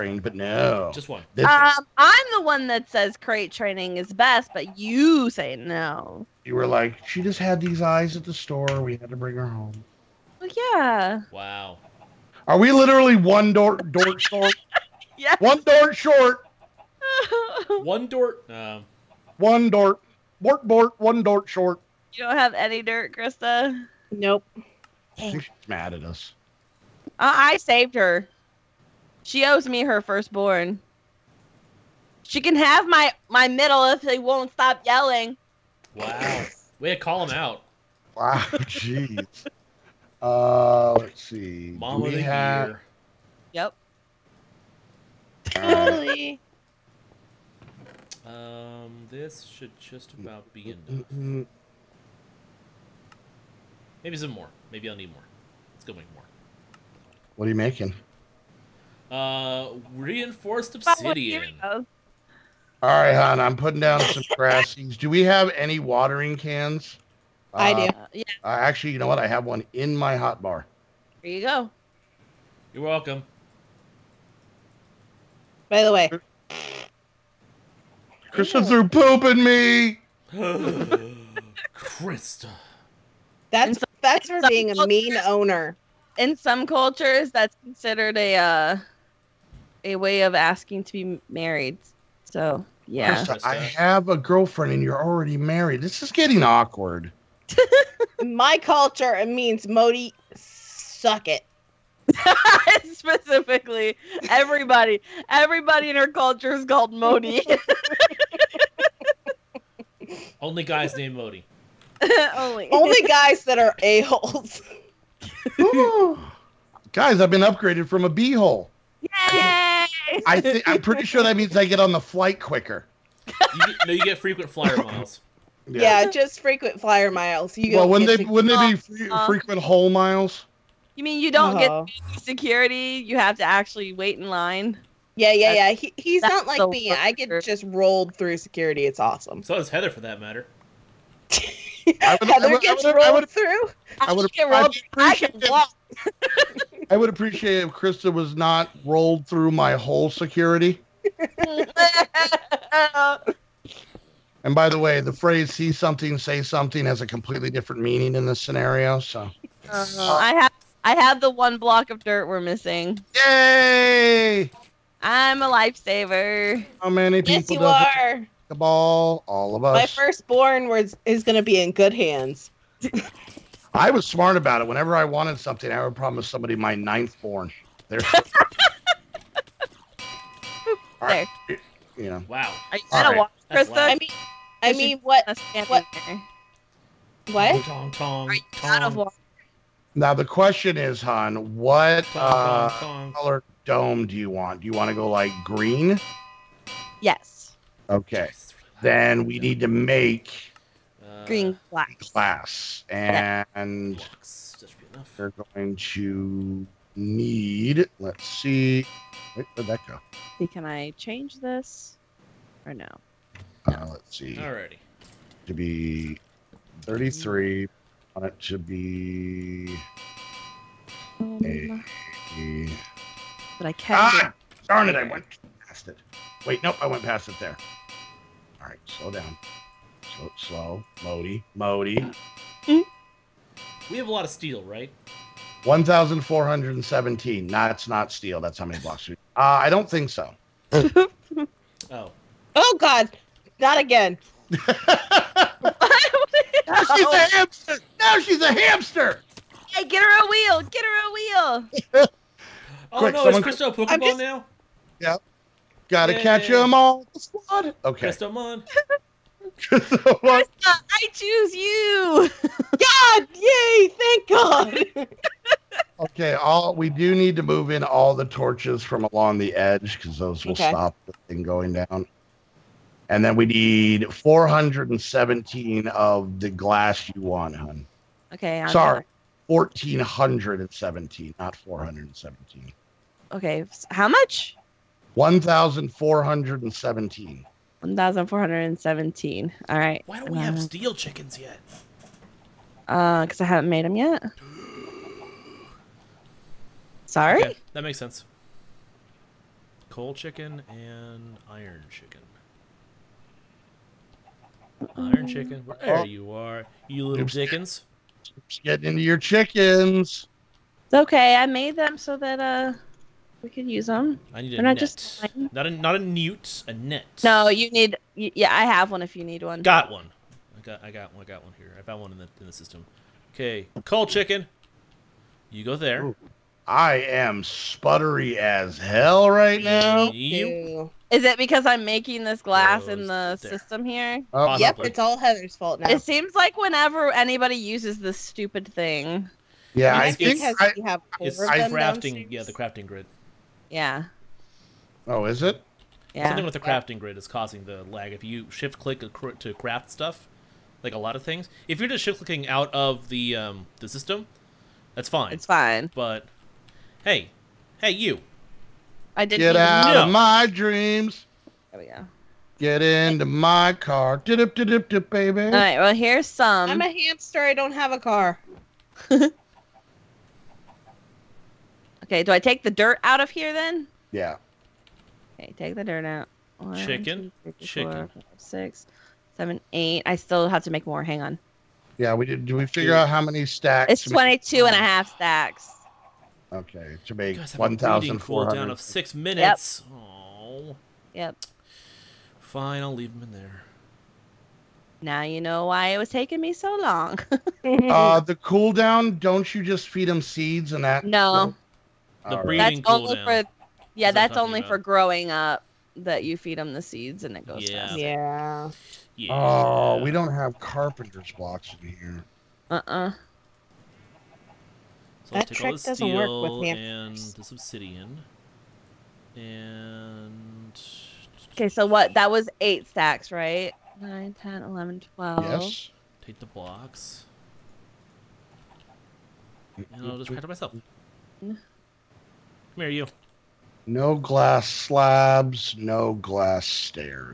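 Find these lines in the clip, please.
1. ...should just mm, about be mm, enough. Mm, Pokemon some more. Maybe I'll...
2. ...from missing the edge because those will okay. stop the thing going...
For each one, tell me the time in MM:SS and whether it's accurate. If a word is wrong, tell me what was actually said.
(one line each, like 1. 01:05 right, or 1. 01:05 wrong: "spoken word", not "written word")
1. 00:49 wrong: "Maybe", not "Pokemon"
2. 04:28 wrong: "along", not "missing".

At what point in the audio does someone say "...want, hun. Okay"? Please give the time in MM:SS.
04:37.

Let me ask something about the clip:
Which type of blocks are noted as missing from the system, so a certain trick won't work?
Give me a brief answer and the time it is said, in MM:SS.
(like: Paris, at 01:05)
Carpenter's blocks, at 06:50.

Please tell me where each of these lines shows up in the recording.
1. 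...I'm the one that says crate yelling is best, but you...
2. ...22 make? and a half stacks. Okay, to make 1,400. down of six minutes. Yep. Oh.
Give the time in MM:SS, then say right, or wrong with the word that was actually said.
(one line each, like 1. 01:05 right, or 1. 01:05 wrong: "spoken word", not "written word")
1. 00:01 wrong: "training", not "yelling"
2. 06:24 right.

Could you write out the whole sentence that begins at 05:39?
Yeah, I think I, it's, I, crafting.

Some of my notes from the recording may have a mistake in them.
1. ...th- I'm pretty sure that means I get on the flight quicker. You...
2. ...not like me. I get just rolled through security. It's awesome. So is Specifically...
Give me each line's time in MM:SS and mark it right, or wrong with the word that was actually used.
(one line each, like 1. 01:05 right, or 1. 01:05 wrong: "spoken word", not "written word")
1. 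02:00 right
2. 02:16 wrong: "Heather", not "Specifically".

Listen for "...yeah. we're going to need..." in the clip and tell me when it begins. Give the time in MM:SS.
03:23.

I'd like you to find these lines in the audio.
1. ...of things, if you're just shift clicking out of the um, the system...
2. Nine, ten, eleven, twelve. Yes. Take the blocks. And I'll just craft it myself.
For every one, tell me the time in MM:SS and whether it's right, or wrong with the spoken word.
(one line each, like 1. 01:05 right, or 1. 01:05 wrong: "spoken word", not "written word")
1. 05:51 right
2. 07:04 right.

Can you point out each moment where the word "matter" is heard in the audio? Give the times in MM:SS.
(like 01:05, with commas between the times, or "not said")
02:20.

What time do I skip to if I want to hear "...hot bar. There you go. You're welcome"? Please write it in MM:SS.
01:10.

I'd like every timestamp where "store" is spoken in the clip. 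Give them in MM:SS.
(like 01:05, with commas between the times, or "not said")
00:08.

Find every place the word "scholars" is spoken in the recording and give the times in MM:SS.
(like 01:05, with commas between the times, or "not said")
not said.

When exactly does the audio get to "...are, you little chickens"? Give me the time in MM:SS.
05:06.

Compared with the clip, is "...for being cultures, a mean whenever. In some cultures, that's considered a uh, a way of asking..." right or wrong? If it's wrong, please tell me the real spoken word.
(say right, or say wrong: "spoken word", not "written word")
wrong: "owner", not "whenever".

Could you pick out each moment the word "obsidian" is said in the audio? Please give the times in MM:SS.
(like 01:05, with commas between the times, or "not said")
01:00, 06:57.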